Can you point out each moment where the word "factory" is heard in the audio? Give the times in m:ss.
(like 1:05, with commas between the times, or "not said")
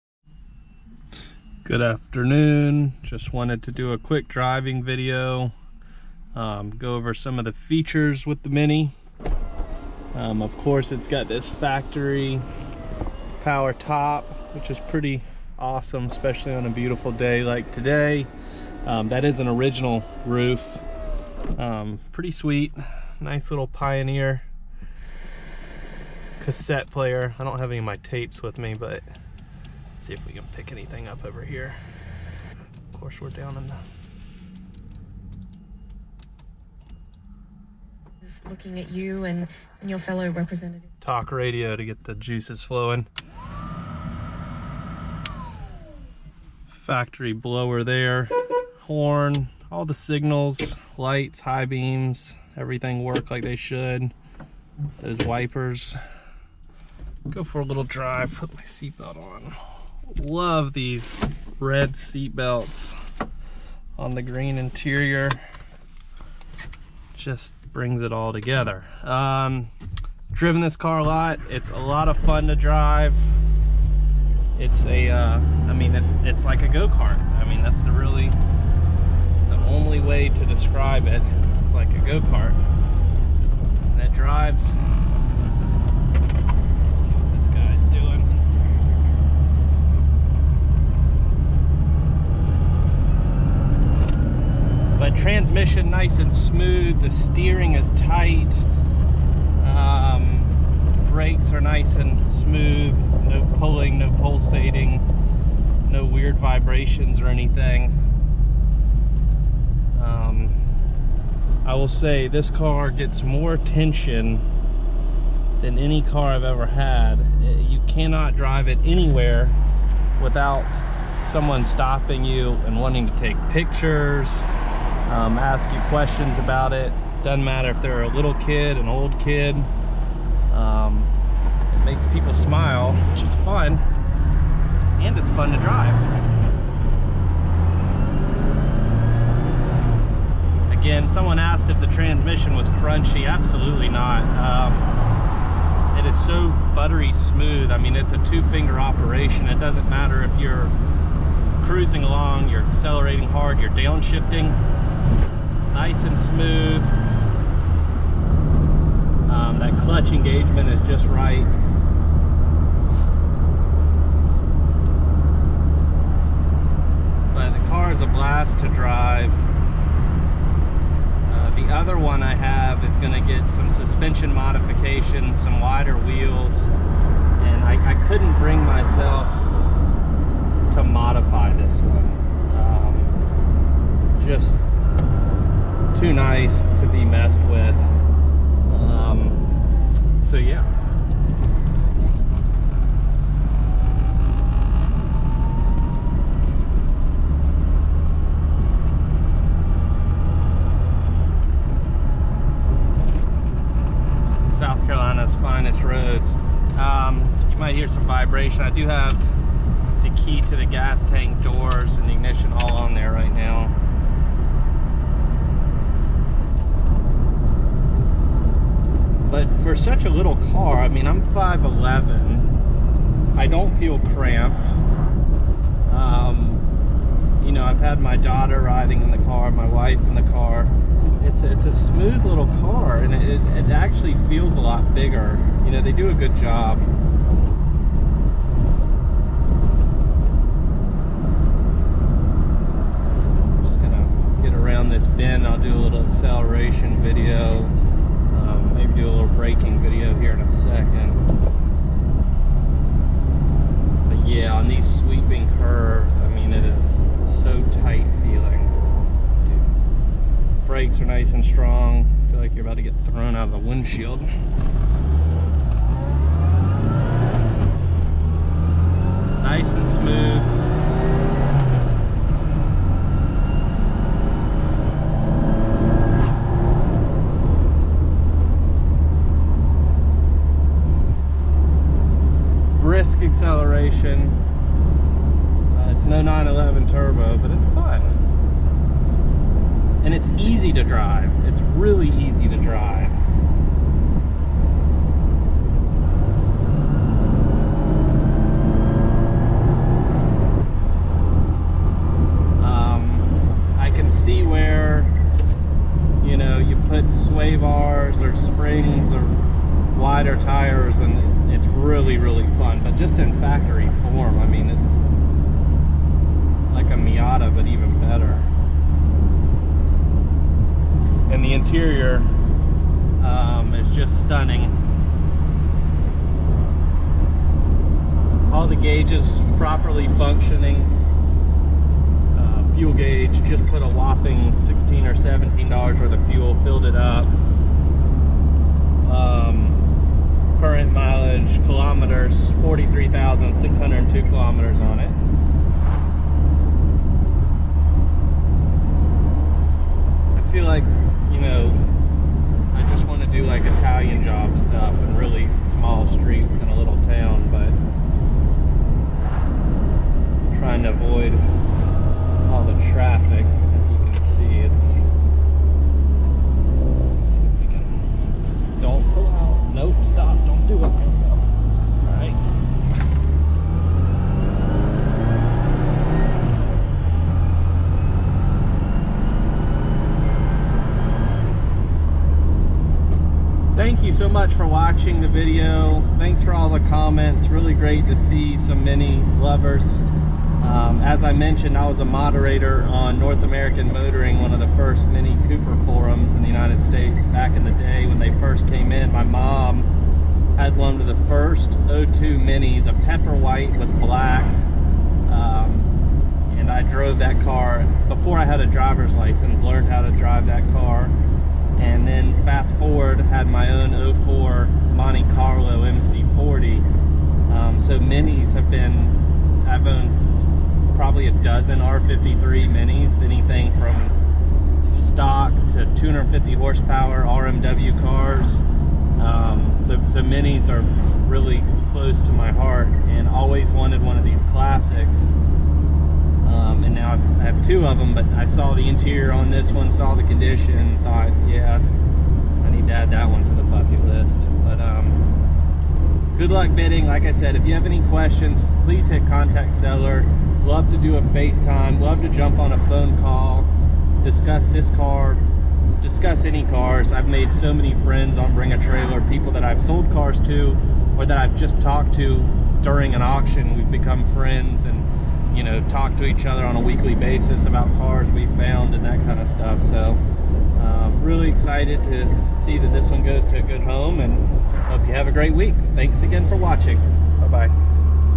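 0:11, 0:46, 5:13.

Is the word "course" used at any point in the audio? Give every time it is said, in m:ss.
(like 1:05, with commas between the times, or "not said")
0:10, 0:32.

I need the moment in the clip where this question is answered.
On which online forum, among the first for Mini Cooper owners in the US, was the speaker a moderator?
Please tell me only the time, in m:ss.
6:33.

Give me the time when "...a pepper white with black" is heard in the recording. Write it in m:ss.
6:42.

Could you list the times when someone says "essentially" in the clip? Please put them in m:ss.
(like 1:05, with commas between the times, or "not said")
not said.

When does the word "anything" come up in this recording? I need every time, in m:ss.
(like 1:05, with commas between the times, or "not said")
0:30, 1:47, 7:03.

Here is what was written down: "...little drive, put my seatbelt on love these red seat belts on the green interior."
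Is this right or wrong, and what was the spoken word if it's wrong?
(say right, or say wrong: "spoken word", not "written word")
right.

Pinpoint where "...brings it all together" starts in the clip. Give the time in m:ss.
1:07.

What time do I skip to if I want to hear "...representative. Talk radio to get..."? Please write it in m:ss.
0:40.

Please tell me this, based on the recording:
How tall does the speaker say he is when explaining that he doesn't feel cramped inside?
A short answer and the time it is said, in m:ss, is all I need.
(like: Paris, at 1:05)
5'11", at 3:41.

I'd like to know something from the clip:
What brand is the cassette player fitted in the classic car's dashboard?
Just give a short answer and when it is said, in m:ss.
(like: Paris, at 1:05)
Pioneer, at 0:23.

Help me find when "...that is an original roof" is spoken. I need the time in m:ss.
0:19.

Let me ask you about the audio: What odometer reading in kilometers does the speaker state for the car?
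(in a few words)
43,602 kilometers.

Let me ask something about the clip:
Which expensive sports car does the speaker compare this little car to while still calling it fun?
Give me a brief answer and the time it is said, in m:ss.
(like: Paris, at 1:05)
911 Turbo, at 4:46.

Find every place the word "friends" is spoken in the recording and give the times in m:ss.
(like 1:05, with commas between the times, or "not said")
7:38, 7:44.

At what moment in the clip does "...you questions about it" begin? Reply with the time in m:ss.
2:05.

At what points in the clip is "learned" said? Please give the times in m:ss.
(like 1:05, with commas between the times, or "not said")
6:49.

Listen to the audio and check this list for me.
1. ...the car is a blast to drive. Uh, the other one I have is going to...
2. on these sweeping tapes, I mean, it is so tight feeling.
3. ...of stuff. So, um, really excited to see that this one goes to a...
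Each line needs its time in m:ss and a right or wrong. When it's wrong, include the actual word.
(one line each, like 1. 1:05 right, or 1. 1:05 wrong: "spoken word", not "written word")
1. 2:47 right
2. 4:14 wrong: "curves", not "tapes"
3. 7:49 right.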